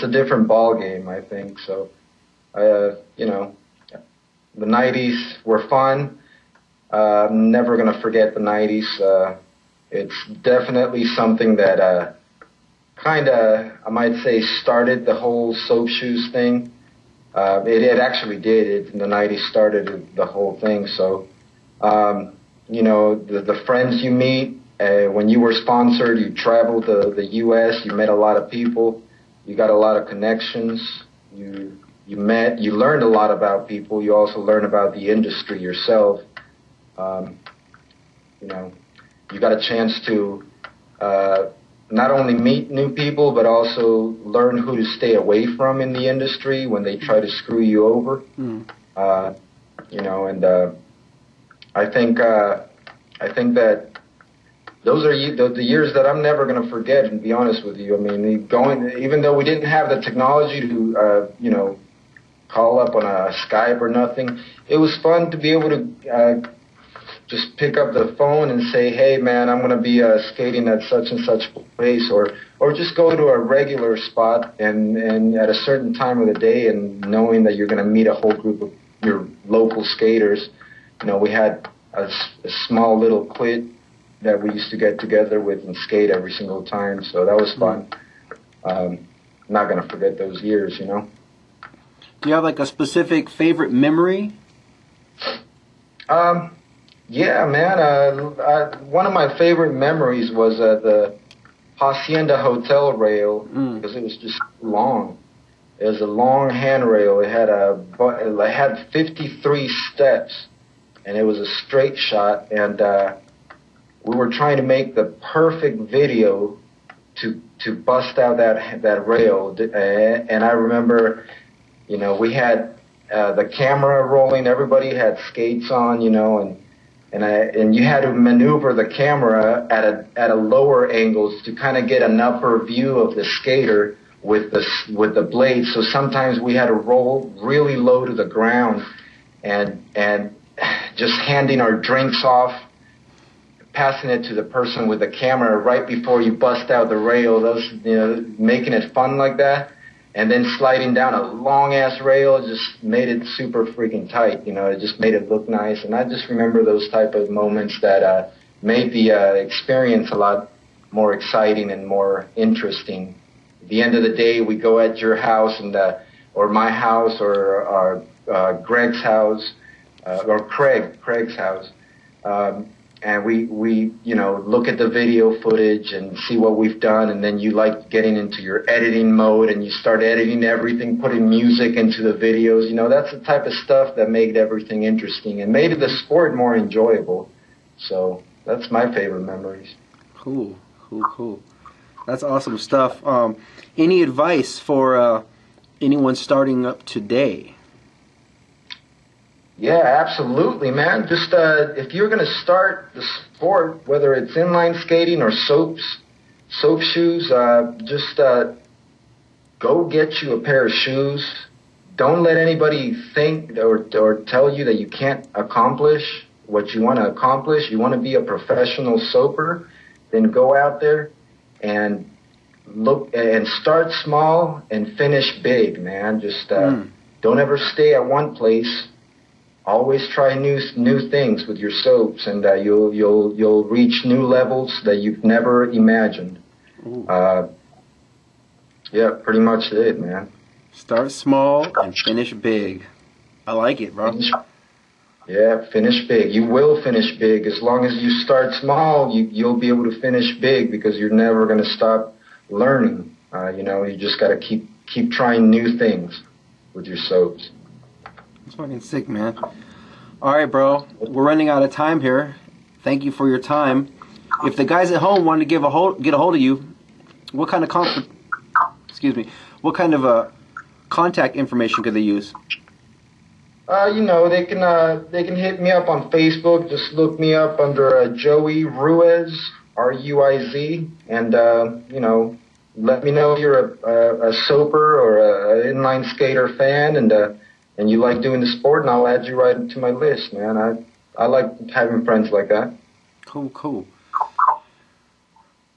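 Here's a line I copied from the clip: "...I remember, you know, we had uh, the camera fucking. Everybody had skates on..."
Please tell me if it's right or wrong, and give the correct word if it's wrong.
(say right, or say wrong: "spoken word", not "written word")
wrong: "rolling", not "fucking".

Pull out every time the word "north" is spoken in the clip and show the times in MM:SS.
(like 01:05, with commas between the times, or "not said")
not said.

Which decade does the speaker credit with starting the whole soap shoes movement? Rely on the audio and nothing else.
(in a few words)
the 90s.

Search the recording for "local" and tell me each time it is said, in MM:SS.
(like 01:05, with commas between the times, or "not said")
01:19.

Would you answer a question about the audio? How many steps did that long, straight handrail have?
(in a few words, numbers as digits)
53.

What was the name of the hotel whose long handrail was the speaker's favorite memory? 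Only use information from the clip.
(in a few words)
Hacienda Hotel.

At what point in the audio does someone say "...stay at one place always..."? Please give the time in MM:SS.
03:47.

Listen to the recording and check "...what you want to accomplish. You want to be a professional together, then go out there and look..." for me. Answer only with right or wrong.
wrong.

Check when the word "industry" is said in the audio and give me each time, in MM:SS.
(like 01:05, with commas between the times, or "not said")
00:35, 00:46.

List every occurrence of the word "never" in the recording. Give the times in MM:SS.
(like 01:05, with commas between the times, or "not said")
00:07, 00:56, 03:55, 04:11.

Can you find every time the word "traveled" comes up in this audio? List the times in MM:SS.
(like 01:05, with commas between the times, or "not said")
00:26.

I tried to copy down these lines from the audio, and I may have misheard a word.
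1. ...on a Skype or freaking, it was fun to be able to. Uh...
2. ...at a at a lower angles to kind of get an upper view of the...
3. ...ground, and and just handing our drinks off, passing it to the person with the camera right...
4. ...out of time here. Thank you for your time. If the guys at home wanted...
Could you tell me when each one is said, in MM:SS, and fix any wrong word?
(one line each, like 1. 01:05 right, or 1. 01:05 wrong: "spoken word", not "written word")
1. 01:02 wrong: "nothing", not "freaking"
2. 02:09 right
3. 02:18 right
4. 04:21 right.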